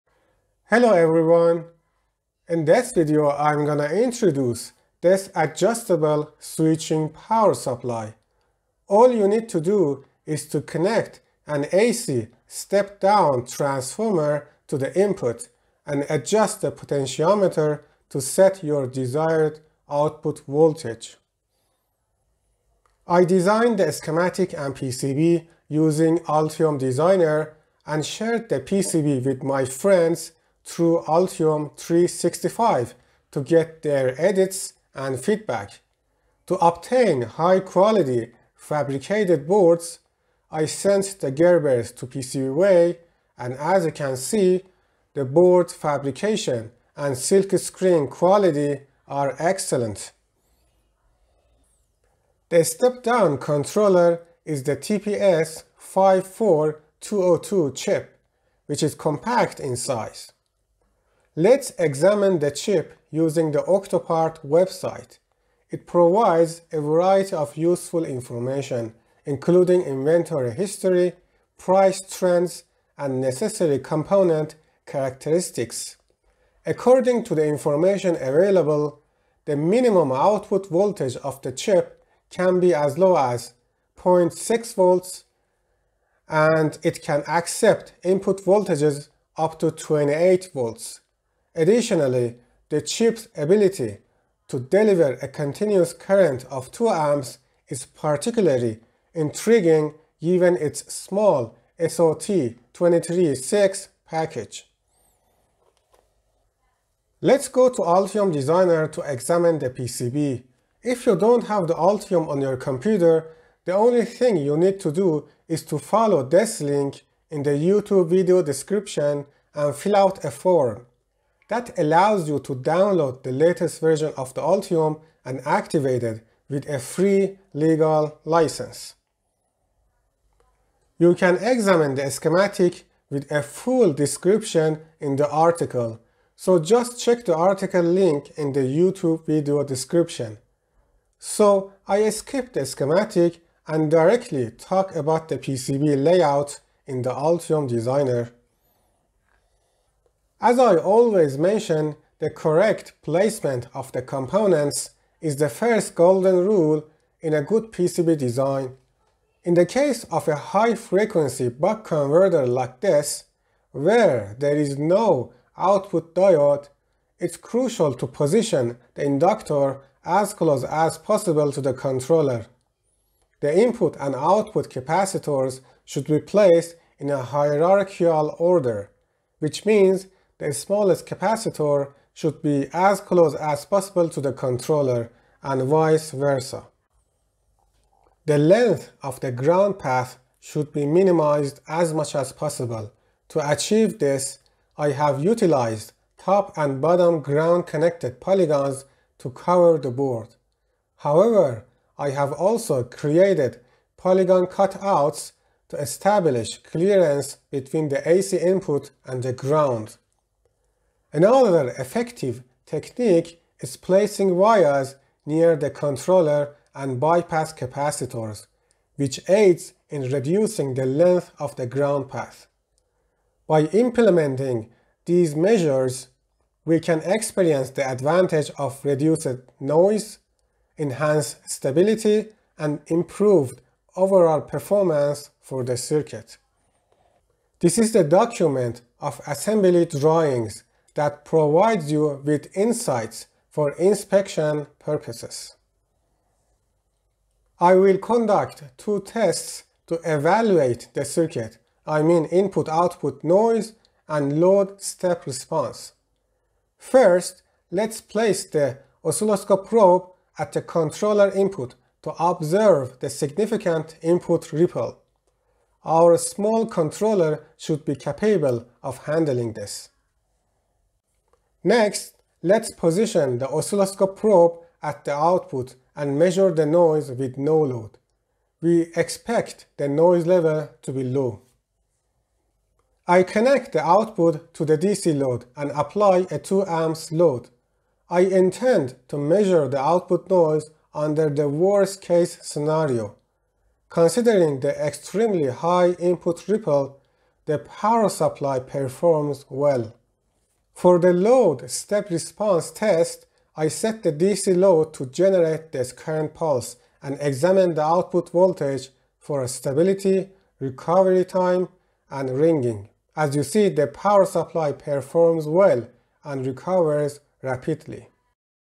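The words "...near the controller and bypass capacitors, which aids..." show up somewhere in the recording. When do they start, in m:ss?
3:35.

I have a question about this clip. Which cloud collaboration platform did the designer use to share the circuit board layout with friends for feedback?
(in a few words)
Altium 365.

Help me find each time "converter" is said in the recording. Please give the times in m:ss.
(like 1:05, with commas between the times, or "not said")
2:41.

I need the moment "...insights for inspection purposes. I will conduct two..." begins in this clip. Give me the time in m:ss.
4:02.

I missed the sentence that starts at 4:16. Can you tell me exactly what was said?
First, let's place the oscilloscope probe at the controller input to observe the significant input ripple.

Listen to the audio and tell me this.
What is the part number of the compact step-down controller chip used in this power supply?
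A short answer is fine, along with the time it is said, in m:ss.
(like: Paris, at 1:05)
TPS54202, at 0:54.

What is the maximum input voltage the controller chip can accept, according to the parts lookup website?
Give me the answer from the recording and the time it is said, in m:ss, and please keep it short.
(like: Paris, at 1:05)
28 volts, at 1:29.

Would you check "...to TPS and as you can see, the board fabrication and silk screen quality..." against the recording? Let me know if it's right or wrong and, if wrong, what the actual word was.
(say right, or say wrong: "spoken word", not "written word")
wrong: "PCBWay", not "TPS".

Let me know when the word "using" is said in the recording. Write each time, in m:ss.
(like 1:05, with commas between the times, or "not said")
0:25, 1:03.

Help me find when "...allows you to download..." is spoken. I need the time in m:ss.
2:01.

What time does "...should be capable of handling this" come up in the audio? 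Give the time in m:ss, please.
4:27.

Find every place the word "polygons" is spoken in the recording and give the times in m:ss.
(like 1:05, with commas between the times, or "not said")
3:18, 3:23.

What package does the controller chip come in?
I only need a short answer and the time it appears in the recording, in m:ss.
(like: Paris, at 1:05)
SOT236, at 1:41.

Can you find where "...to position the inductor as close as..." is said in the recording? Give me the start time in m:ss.
2:47.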